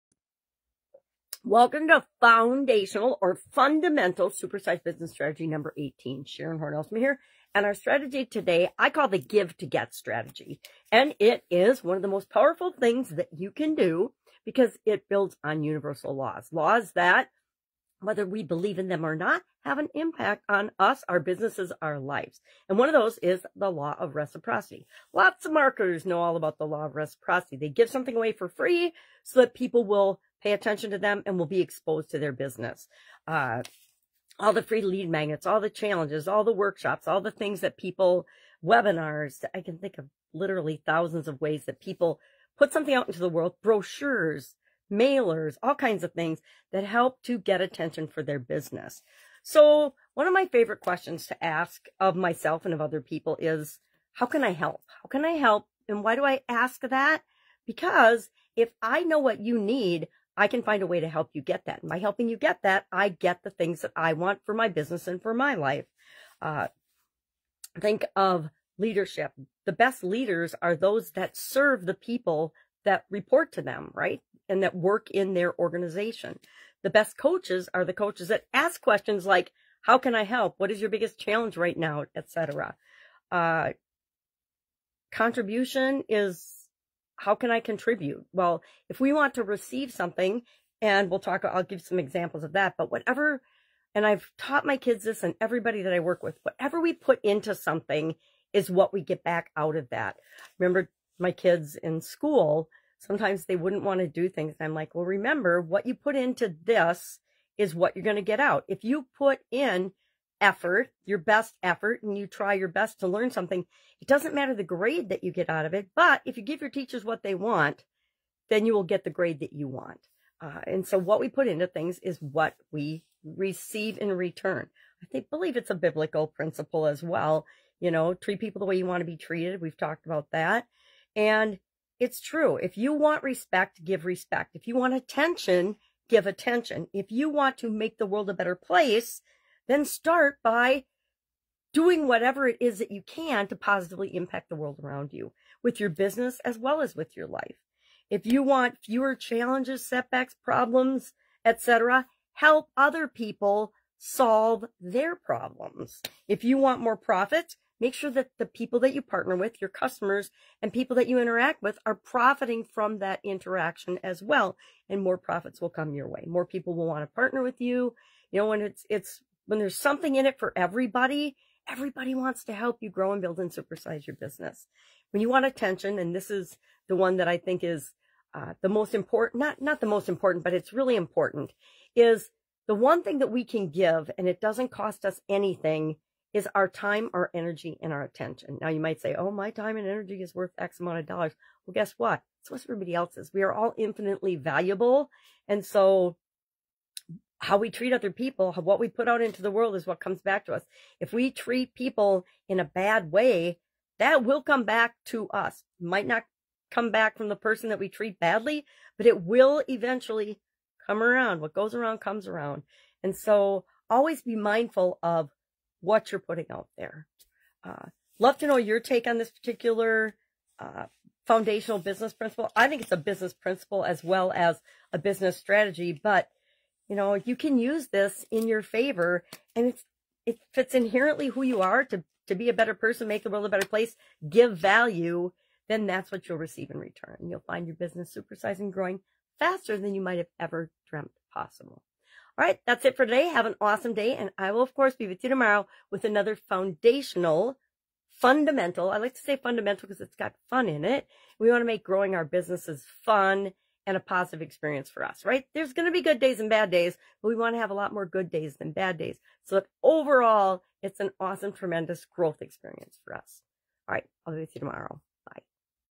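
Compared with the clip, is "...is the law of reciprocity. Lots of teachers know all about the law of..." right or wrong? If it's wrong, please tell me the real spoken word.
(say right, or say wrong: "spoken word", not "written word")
wrong: "marketers", not "teachers".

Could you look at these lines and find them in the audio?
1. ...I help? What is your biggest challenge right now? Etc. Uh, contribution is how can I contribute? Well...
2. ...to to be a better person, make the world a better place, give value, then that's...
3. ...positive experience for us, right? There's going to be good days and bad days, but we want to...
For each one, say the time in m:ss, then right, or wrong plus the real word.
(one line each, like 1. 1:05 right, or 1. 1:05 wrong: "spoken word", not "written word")
1. 1:20 right
2. 3:51 right
3. 4:13 right.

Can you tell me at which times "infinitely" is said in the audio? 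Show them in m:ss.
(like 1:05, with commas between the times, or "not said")
3:13.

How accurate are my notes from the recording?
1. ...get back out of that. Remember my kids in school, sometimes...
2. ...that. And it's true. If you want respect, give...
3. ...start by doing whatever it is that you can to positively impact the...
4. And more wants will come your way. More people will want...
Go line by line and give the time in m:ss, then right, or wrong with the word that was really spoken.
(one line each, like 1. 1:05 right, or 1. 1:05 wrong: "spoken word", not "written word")
1. 1:39 right
2. 2:10 right
3. 2:19 right
4. 2:44 wrong: "profits", not "wants".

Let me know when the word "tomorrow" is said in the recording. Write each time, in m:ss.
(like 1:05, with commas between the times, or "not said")
4:05, 4:24.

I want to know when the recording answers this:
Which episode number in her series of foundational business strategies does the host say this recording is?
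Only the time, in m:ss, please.
0:05.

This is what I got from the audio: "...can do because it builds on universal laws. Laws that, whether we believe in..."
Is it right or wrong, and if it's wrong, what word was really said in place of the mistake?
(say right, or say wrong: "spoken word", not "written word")
right.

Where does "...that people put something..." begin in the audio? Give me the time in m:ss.
0:41.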